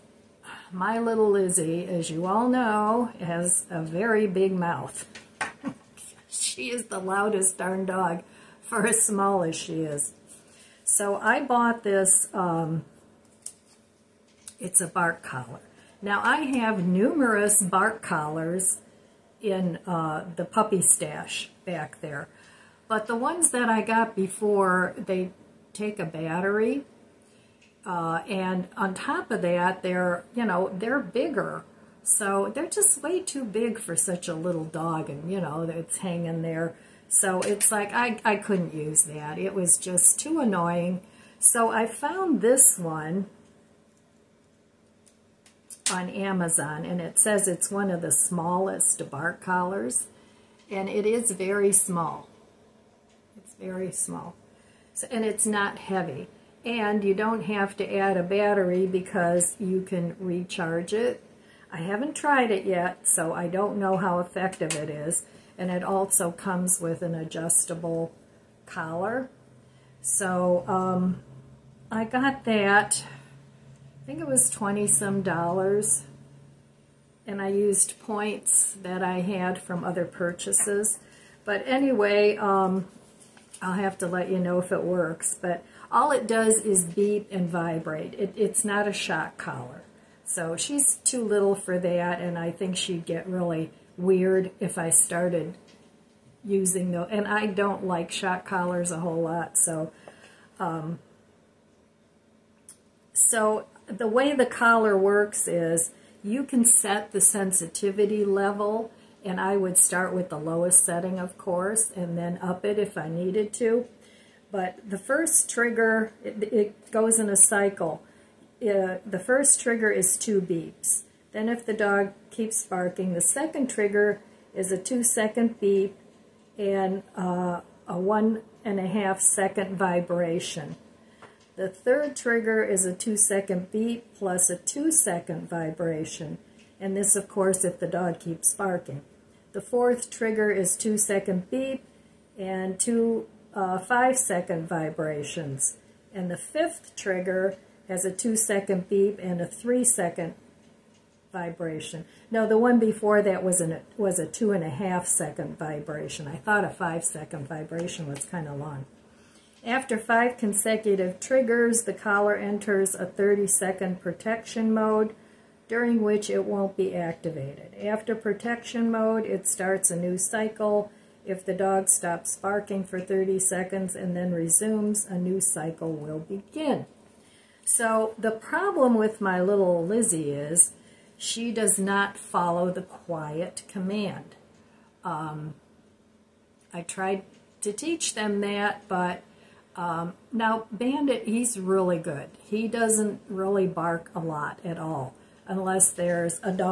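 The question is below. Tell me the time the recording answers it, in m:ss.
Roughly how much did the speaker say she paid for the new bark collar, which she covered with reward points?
1:14.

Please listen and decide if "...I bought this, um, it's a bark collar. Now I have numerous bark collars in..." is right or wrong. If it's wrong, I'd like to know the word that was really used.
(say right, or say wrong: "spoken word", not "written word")
right.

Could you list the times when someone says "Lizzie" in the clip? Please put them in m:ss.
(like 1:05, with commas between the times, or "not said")
0:01, 2:59.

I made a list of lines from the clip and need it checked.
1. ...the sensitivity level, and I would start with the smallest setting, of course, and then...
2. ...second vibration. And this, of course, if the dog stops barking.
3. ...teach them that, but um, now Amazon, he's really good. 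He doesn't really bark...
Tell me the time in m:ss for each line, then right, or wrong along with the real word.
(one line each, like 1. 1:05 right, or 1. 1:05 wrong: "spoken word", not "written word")
1. 1:47 wrong: "lowest", not "smallest"
2. 2:14 wrong: "keeps", not "stops"
3. 3:07 wrong: "Bandit", not "Amazon".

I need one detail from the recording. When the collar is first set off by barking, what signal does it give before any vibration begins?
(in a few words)
2 beeps.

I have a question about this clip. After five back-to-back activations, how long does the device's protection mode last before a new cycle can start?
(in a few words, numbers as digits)
30 seconds.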